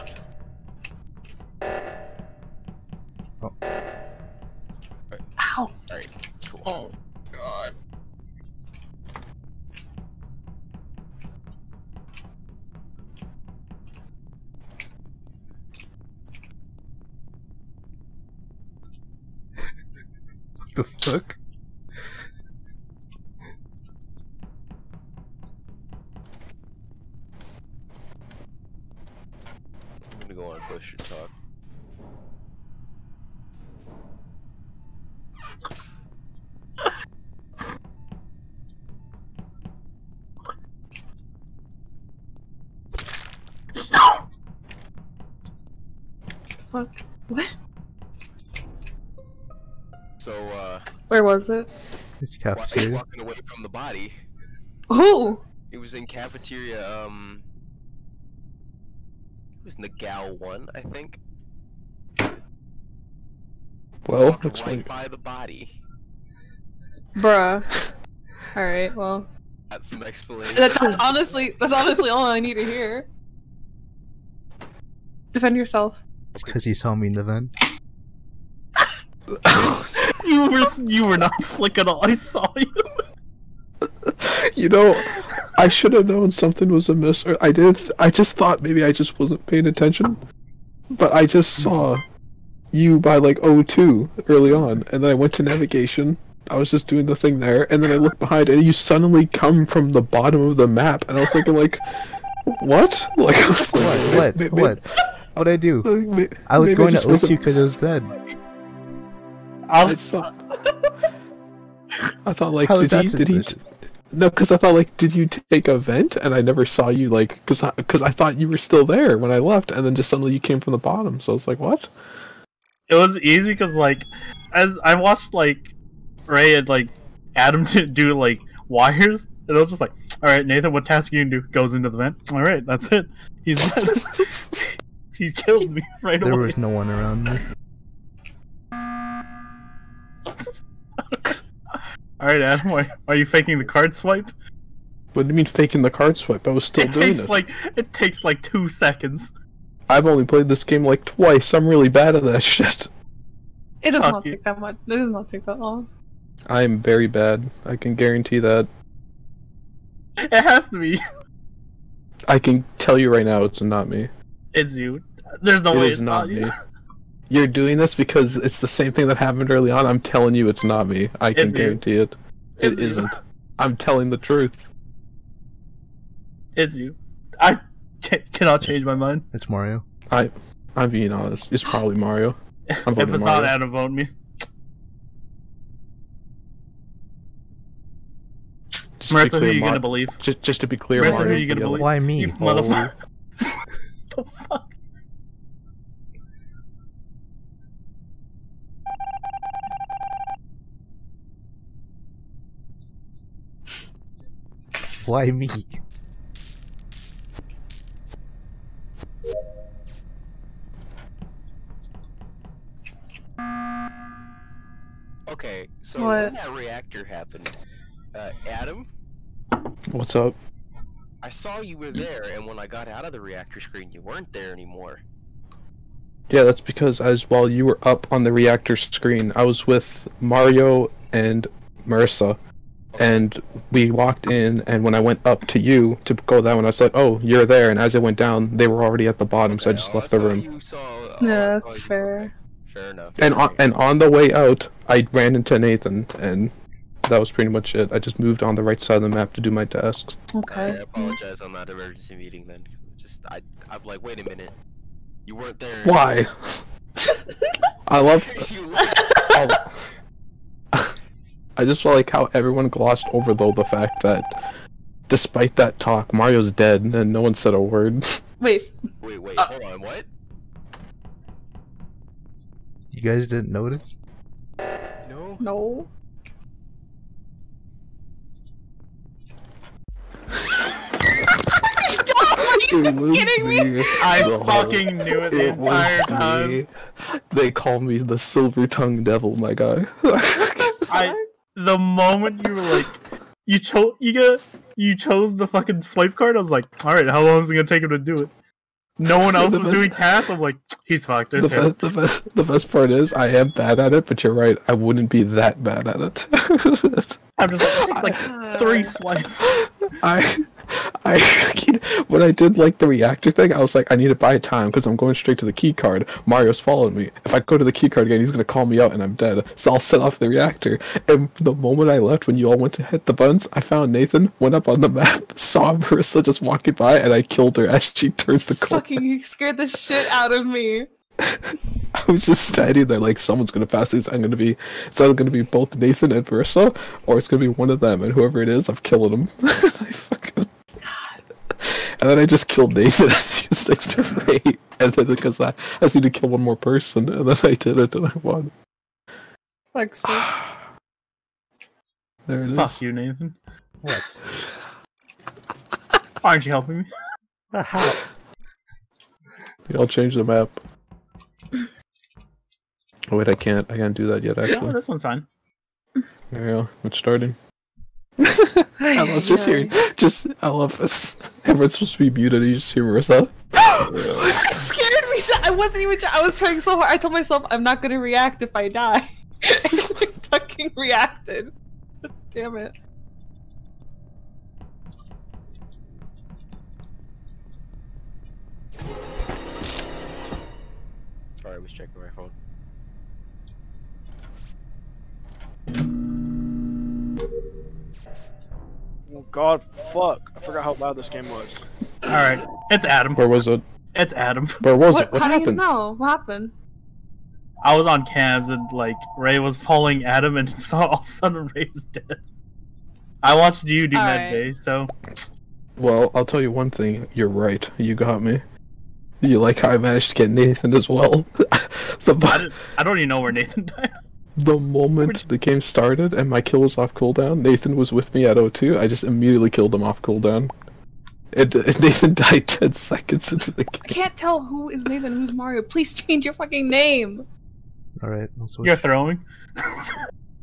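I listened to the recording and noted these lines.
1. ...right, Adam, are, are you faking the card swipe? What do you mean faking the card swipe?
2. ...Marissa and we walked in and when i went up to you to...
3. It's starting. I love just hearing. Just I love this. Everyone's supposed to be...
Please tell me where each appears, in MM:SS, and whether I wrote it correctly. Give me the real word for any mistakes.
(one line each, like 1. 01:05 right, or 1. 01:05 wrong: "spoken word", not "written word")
1. 02:22 right
2. 03:51 right
3. 06:06 right.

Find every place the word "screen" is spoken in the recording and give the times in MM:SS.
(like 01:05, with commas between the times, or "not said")
03:43, 03:48.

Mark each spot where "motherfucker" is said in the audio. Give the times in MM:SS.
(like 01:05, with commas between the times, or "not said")
03:12.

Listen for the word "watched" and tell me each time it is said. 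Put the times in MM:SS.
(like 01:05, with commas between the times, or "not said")
02:04, 06:53.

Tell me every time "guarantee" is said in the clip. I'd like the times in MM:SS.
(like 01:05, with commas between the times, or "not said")
02:37, 02:51.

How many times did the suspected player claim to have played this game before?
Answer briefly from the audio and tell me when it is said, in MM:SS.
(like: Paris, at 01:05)
twice, at 02:31.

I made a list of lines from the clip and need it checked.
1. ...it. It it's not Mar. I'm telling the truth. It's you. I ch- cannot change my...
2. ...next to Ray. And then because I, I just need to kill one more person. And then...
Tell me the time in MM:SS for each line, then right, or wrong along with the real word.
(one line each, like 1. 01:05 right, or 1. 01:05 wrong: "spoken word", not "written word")
1. 02:51 wrong: "You", not "Mar"
2. 05:43 right.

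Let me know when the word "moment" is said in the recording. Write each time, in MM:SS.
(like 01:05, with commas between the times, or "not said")
04:51, 05:21, 07:04.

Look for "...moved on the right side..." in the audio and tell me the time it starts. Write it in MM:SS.
04:08.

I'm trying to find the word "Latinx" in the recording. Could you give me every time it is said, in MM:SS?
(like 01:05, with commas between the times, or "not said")
not said.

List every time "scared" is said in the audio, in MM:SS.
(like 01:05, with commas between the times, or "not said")
05:29, 06:14.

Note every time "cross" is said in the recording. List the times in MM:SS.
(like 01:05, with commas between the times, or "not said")
not said.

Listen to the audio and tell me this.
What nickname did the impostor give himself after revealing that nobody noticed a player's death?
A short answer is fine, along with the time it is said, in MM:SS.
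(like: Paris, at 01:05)
silver tongue devil, at 04:48.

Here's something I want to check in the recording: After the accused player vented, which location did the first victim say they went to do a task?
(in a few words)
navigation.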